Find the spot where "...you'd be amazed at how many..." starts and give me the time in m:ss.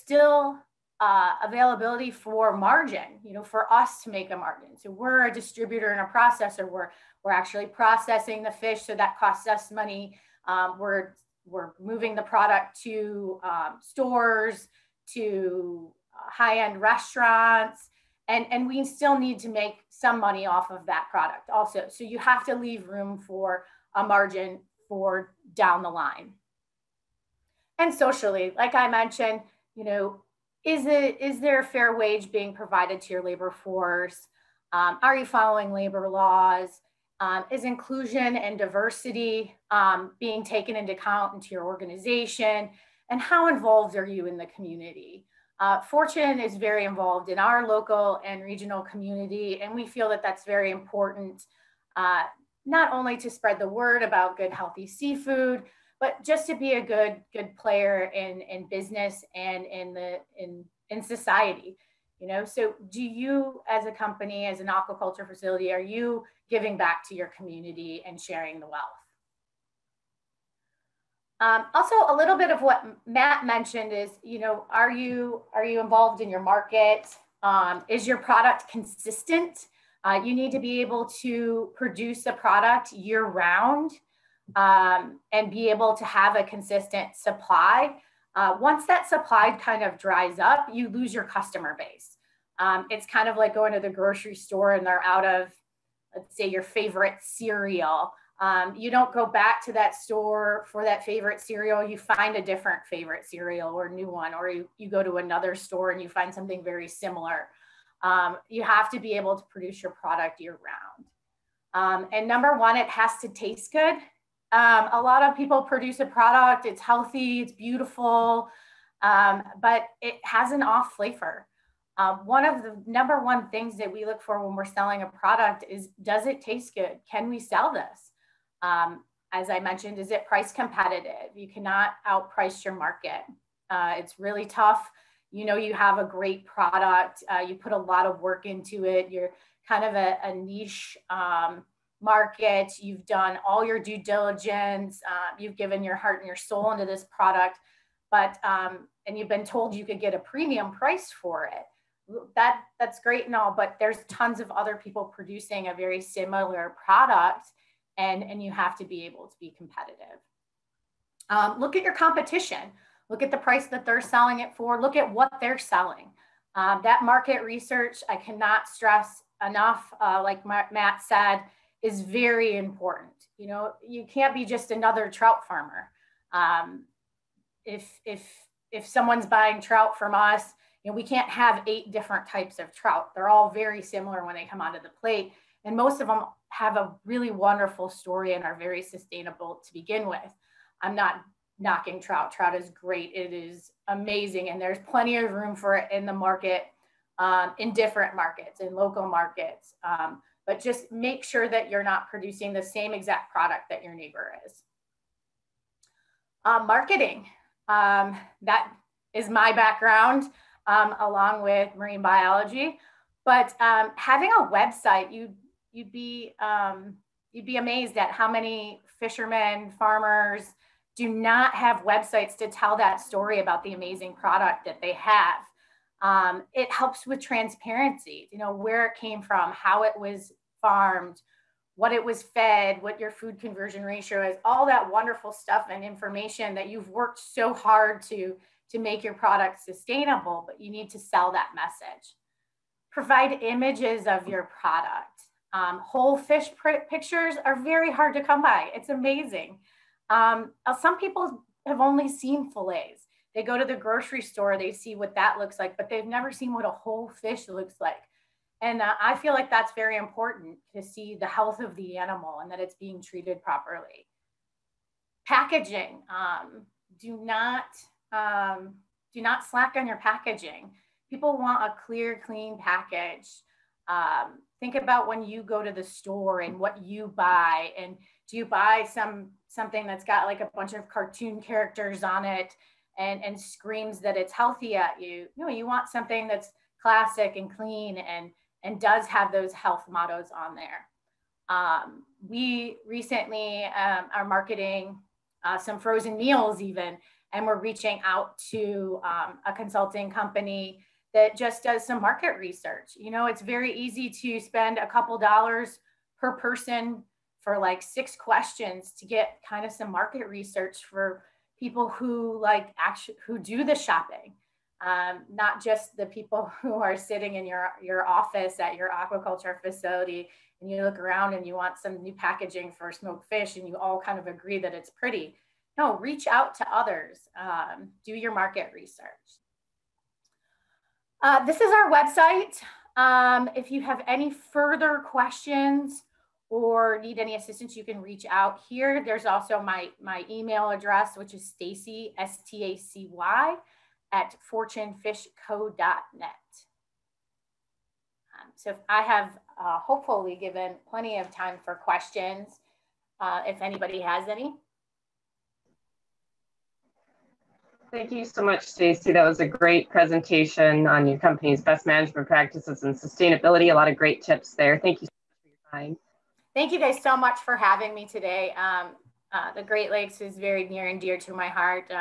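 3:37.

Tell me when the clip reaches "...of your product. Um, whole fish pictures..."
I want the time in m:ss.
4:04.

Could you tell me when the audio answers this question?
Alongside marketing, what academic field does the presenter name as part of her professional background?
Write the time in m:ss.
3:31.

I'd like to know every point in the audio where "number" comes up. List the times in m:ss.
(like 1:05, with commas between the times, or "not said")
1:52, 2:02.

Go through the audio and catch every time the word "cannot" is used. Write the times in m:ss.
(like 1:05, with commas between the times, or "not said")
2:11, 2:48.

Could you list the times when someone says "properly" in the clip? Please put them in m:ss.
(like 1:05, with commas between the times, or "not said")
4:23.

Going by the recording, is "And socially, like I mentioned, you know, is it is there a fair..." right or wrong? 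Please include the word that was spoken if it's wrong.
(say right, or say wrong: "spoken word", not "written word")
right.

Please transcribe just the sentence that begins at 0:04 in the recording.
So we're a distributor and a processor.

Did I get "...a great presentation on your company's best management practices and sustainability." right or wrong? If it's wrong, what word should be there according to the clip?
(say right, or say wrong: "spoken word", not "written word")
right.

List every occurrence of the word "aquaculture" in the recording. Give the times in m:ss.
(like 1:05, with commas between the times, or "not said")
1:04, 5:18.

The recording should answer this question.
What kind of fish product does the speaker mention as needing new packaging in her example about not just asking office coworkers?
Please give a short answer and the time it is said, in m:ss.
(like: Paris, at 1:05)
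smoked fish, at 5:22.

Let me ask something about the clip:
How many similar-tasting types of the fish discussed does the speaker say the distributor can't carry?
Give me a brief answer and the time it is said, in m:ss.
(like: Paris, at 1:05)
8, at 3:01.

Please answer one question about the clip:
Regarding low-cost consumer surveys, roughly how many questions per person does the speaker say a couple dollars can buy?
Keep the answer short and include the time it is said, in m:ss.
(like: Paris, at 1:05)
6, at 5:07.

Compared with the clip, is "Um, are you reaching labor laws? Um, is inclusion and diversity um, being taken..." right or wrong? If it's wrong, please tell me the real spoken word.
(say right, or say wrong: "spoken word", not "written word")
wrong: "following", not "reaching".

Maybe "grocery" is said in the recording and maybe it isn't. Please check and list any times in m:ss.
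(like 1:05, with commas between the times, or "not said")
1:33, 4:13.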